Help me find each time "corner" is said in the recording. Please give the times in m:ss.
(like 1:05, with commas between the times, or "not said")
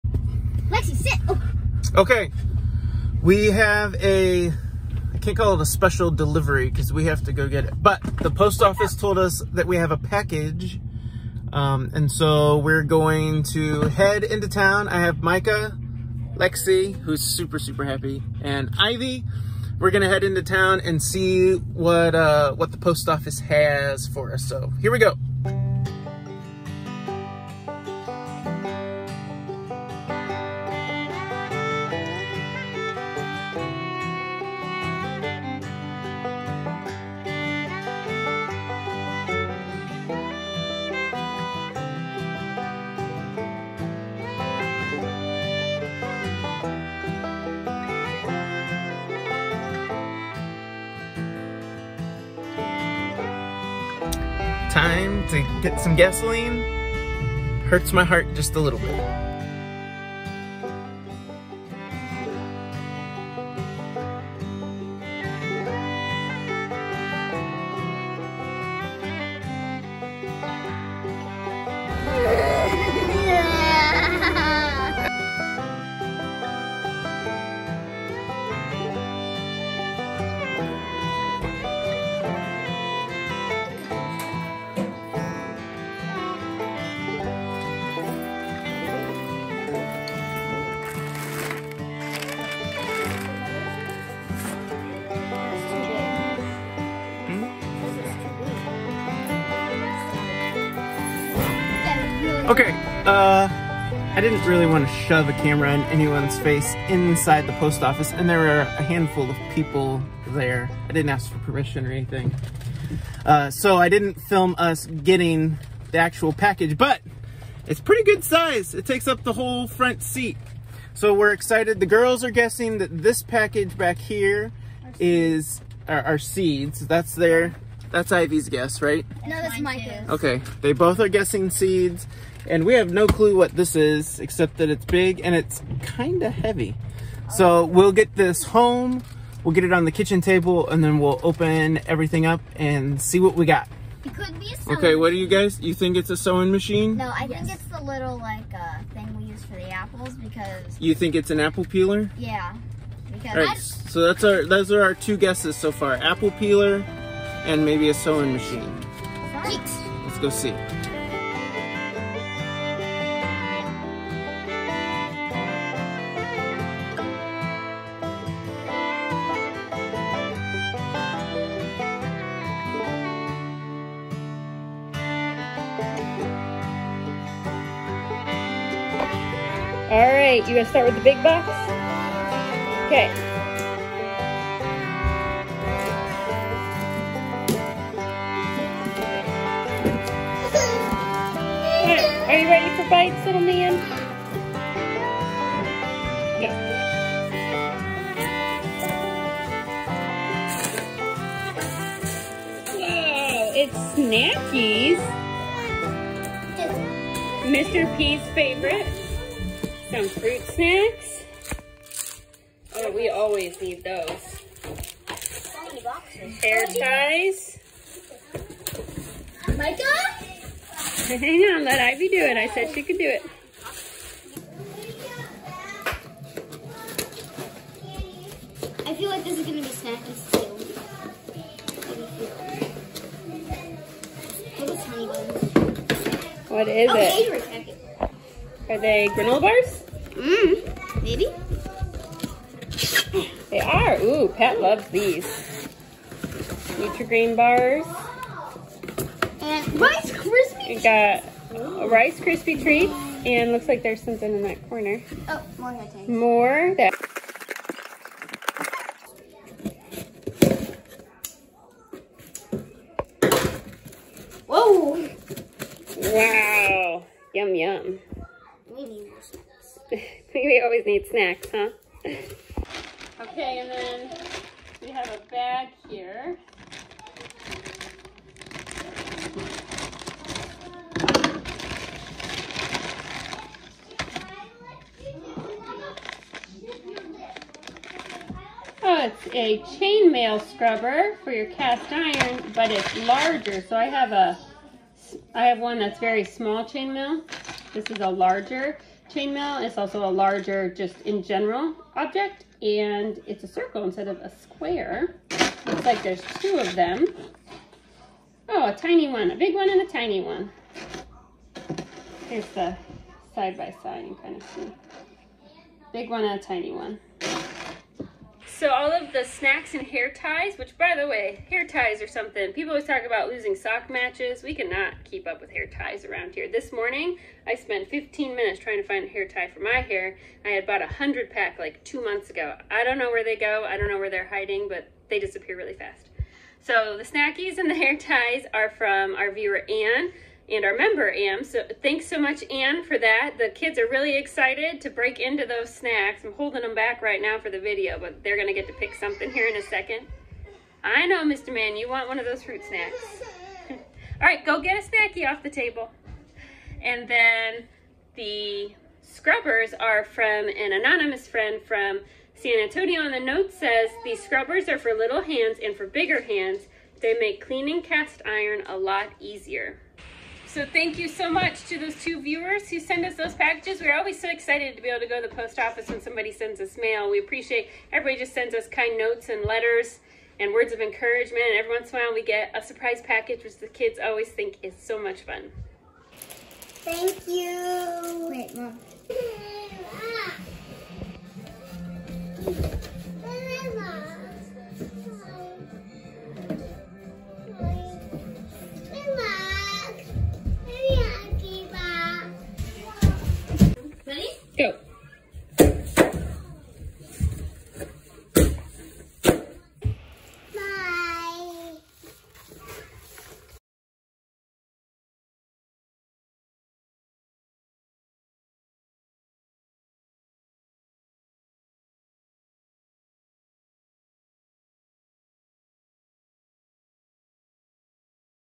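4:14.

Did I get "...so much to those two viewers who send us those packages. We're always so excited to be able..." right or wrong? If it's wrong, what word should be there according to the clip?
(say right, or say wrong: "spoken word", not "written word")
right.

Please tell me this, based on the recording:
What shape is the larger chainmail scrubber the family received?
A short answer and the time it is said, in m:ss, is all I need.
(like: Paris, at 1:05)
A circle, at 5:03.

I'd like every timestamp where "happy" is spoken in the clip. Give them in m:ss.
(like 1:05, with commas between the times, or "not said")
0:17.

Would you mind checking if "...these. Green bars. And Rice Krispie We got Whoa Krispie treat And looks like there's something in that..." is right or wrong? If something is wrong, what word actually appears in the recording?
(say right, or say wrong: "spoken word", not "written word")
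wrong: "Rice", not "Whoa".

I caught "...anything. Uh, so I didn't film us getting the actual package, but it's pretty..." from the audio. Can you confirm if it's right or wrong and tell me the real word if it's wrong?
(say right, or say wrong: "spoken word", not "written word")
right.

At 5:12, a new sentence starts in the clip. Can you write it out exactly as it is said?
Here's the side by side, you kind of see.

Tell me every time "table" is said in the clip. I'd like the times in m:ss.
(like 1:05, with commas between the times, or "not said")
2:20, 5:55.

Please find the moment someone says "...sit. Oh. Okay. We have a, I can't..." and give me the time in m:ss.
0:00.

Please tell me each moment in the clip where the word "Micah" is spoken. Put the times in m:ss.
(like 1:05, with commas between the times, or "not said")
0:15, 3:39.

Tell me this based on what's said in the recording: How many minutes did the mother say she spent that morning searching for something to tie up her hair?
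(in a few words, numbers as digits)
15.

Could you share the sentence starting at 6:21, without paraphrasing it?
And every once in a while we get a surprise package, which the kids always think is so much fun.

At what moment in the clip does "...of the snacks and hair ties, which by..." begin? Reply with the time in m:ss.
5:18.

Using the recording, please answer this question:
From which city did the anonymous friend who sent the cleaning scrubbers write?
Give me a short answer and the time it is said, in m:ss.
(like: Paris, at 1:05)
San Antonio, at 6:02.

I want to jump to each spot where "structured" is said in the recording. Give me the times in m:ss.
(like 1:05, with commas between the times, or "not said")
not said.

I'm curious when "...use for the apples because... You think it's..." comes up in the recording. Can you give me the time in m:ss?
2:29.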